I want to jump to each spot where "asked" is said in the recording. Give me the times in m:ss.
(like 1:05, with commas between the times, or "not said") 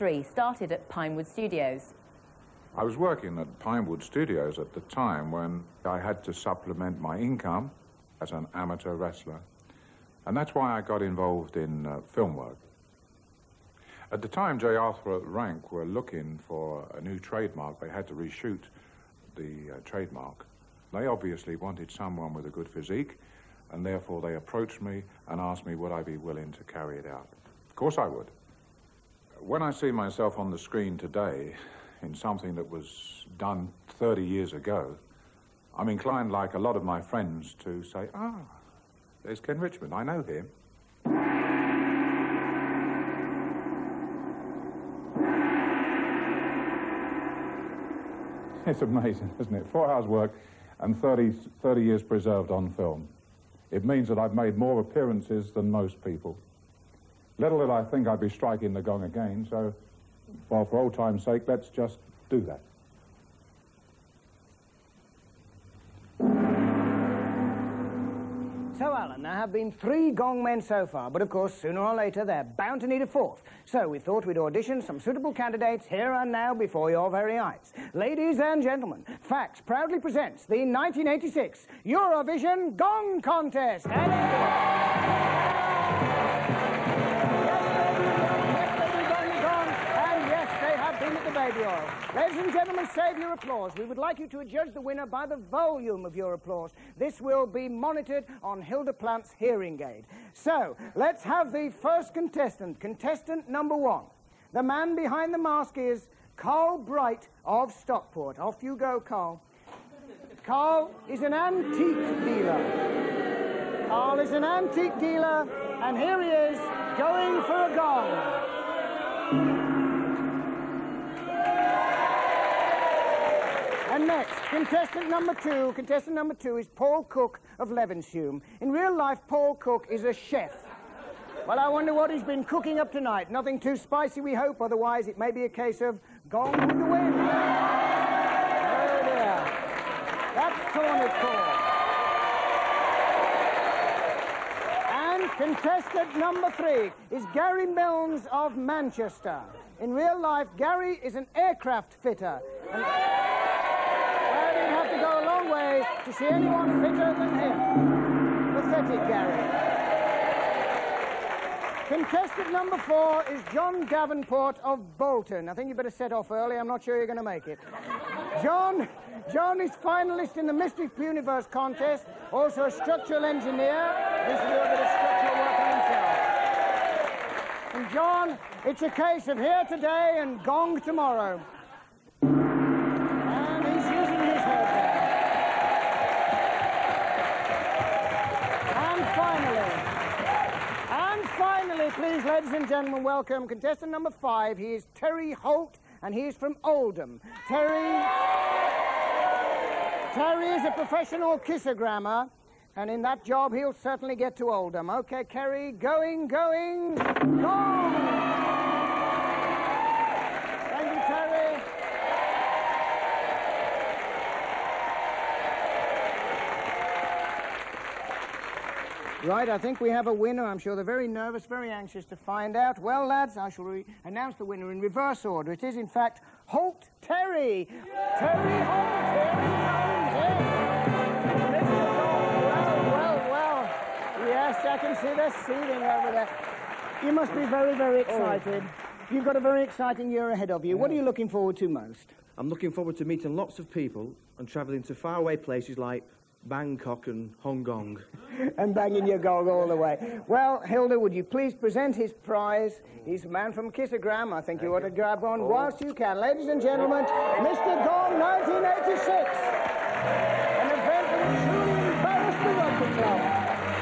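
0:25.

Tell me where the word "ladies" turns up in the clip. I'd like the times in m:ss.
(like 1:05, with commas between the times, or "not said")
1:17, 1:32, 3:12, 4:16.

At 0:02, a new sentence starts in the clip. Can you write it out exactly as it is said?
I was working at Pinewood Studios at the time when I had to supplement my income as an amateur wrestler.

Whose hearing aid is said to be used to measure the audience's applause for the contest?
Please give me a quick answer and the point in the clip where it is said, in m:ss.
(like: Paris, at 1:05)
Hilda Plant, at 1:38.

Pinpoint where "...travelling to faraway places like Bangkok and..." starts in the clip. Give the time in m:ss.
4:04.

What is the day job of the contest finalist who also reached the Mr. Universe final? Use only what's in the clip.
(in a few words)
structural engineer.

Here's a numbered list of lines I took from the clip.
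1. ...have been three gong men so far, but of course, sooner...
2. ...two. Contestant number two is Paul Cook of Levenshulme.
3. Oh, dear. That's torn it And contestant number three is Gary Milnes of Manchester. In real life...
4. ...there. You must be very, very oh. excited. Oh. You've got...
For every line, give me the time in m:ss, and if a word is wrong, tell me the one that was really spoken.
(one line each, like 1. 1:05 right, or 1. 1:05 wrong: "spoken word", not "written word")
1. 1:09 right
2. 2:05 right
3. 2:17 right
4. 3:56 right.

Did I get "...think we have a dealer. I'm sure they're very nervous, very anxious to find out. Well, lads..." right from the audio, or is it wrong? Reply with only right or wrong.
wrong.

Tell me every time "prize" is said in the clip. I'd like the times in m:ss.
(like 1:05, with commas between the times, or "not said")
4:12.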